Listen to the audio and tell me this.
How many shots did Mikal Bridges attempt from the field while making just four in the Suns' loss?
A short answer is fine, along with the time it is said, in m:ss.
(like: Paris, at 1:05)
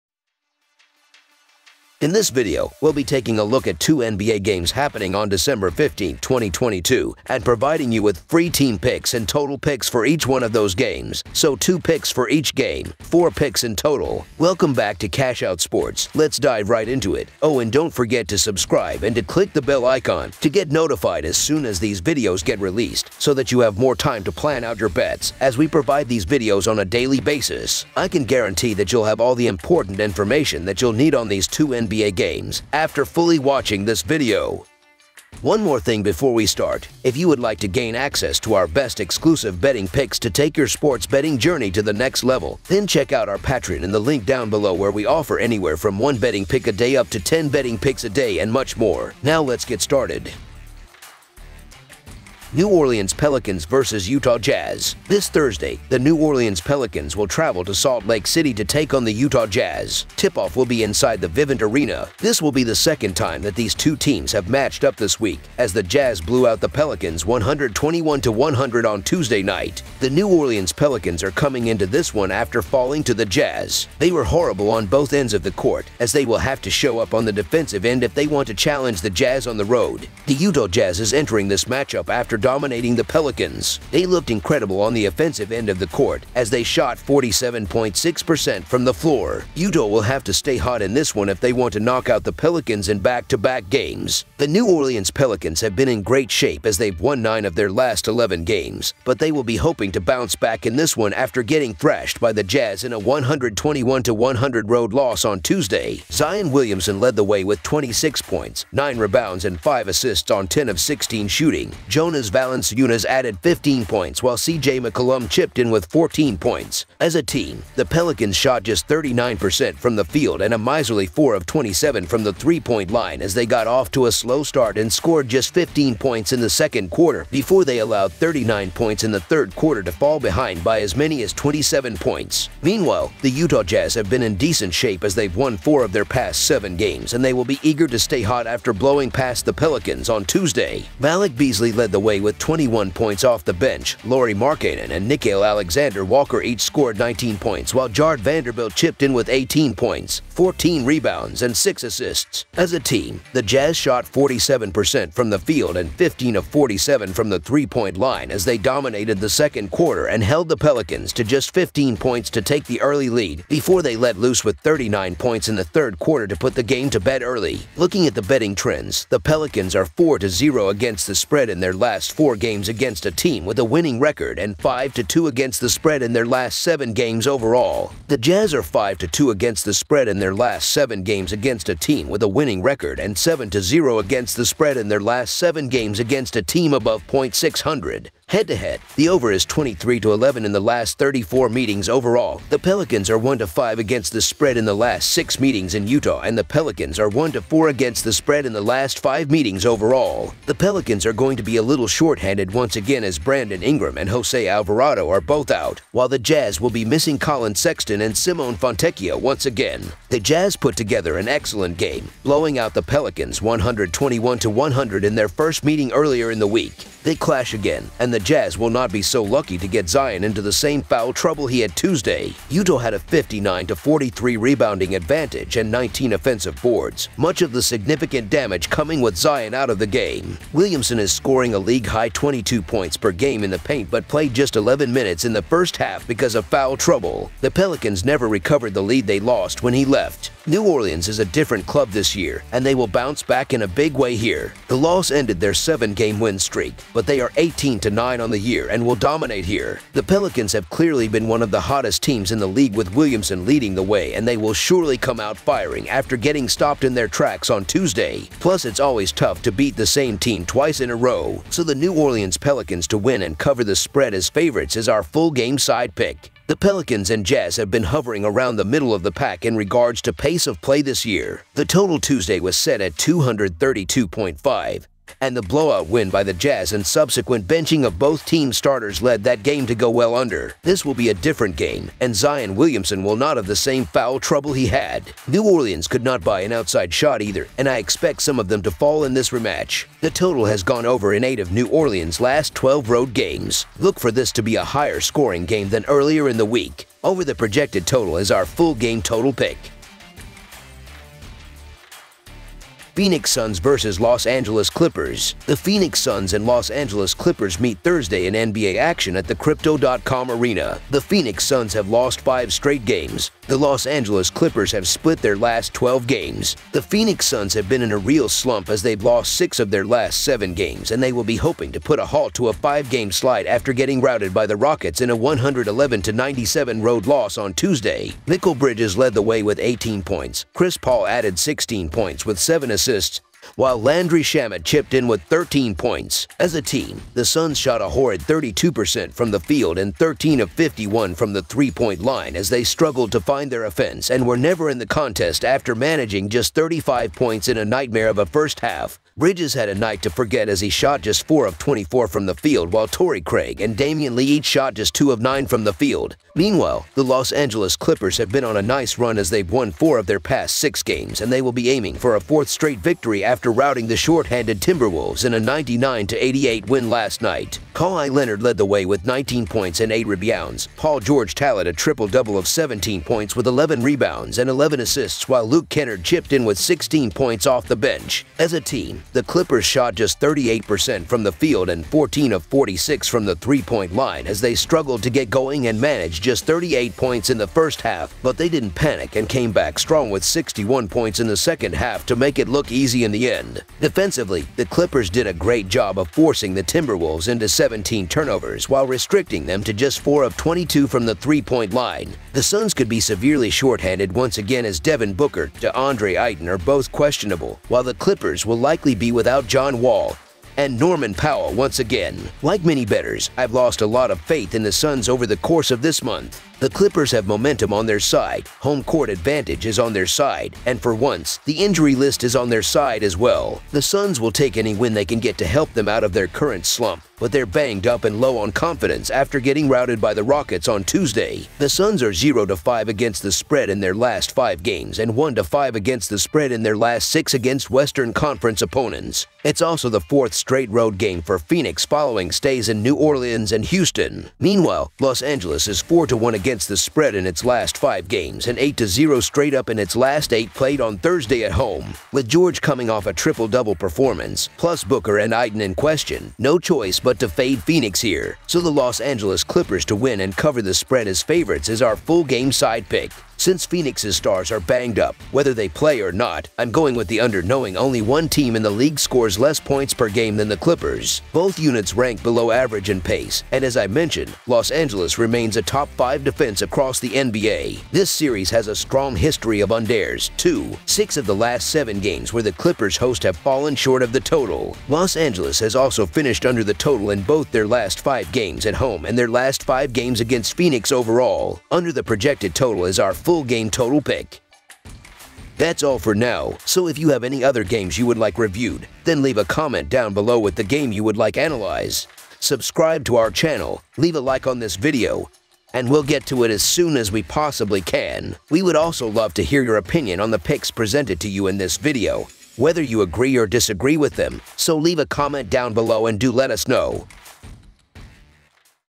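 24, at 5:51.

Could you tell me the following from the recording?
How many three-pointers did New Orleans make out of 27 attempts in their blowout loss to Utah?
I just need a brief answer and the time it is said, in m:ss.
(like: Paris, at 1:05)
4, at 2:01.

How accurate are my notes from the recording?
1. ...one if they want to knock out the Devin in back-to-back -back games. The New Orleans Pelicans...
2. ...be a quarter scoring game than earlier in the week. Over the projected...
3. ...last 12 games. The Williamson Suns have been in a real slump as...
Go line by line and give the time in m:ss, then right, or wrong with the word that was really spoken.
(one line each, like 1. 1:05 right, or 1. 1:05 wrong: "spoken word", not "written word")
1. 1:31 wrong: "Pelicans", not "Devin"
2. 4:54 wrong: "higher", not "quarter"
3. 5:15 wrong: "Phoenix", not "Williamson".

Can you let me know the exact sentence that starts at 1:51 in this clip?
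Jonas Valanciunas added 15 points, while CJ McCollum chipped in with 14 points.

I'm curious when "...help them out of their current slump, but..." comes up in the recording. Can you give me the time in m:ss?
7:05.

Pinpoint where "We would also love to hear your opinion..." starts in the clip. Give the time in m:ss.
8:28.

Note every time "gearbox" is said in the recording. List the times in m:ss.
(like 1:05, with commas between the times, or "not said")
not said.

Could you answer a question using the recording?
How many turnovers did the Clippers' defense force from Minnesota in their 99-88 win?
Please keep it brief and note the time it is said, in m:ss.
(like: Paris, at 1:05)
17, at 6:37.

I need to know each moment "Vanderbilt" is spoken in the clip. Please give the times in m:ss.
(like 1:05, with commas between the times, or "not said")
2:28.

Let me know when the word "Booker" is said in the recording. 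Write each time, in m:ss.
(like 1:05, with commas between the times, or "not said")
6:45, 7:34.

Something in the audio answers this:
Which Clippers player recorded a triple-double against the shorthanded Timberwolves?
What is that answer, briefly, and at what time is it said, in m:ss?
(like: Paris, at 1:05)
Paul George, at 6:10.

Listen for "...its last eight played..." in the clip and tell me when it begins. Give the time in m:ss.
7:29.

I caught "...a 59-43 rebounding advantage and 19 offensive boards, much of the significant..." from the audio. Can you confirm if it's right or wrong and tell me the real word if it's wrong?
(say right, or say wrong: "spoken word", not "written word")
right.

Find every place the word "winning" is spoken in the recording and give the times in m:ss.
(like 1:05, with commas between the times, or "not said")
2:53, 3:02.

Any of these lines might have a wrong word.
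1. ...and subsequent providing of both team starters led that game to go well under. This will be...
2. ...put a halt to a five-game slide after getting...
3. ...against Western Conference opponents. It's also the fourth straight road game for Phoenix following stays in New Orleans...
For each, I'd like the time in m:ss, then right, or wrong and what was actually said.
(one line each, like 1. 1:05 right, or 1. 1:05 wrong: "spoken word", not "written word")
1. 4:36 wrong: "benching", not "providing"
2. 5:21 right
3. 7:17 right.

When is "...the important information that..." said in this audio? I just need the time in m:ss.
0:29.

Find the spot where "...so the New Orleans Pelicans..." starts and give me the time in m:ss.
4:21.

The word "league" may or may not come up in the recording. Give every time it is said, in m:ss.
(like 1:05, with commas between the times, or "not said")
3:51, 4:12, 7:48.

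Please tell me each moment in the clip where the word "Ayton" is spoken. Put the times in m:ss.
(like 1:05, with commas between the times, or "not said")
6:46, 7:35.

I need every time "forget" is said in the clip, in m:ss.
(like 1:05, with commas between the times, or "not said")
0:17, 5:50.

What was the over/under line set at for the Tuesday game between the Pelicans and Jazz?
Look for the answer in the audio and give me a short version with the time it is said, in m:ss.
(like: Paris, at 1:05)
232.5, at 4:32.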